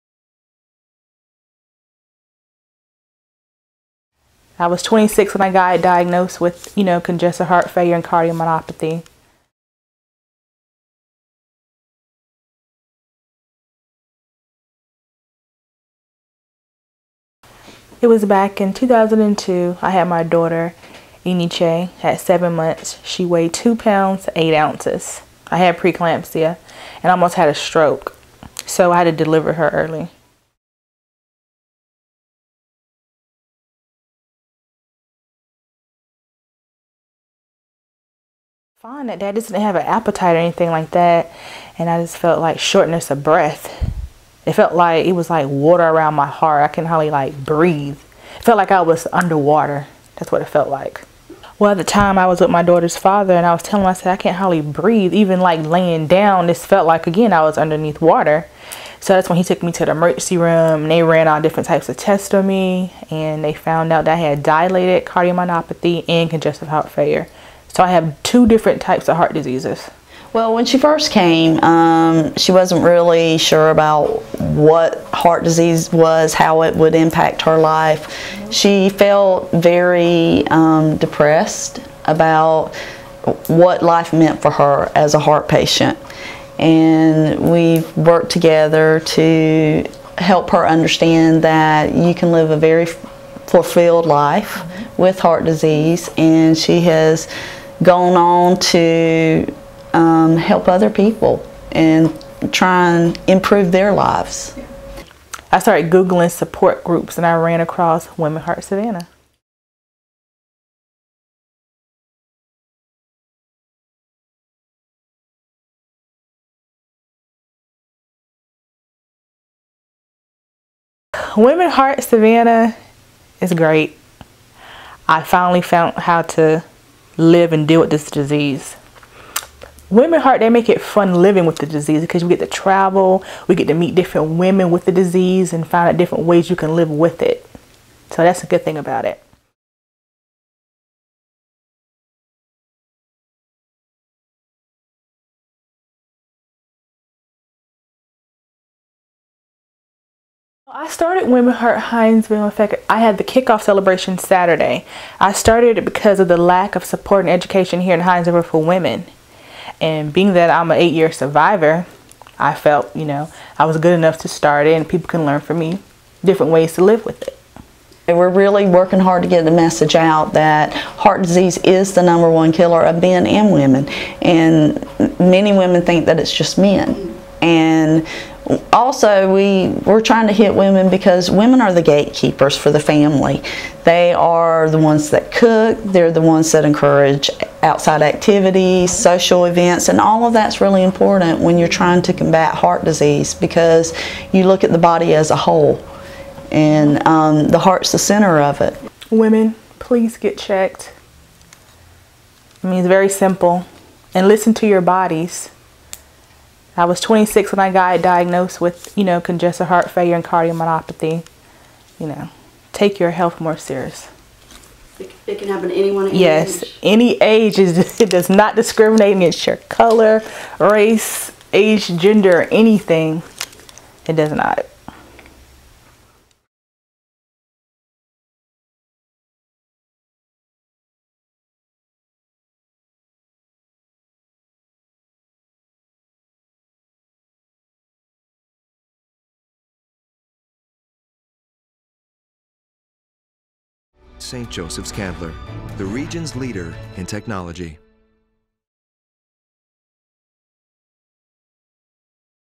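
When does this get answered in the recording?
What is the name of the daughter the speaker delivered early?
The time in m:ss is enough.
0:21.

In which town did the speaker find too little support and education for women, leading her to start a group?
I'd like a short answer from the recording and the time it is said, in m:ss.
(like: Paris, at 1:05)
Hinesville, at 2:37.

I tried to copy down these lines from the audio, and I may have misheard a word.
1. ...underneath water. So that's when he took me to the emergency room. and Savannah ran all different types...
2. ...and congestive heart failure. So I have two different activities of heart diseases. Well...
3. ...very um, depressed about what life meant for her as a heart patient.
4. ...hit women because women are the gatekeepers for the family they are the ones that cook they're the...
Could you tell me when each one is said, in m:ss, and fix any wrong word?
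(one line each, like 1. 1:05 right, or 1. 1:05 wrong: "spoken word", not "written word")
1. 0:57 wrong: "They", not "Savannah"
2. 1:06 wrong: "types", not "activities"
3. 1:19 right
4. 3:00 right.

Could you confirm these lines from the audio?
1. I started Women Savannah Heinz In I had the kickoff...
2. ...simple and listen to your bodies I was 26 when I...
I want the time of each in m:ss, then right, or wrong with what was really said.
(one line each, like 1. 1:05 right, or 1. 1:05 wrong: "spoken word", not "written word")
1. 2:30 wrong: "Heart", not "Savannah"
2. 3:23 right.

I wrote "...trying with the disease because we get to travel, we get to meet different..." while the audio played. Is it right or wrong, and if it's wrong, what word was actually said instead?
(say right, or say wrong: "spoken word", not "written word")
wrong: "living", not "trying".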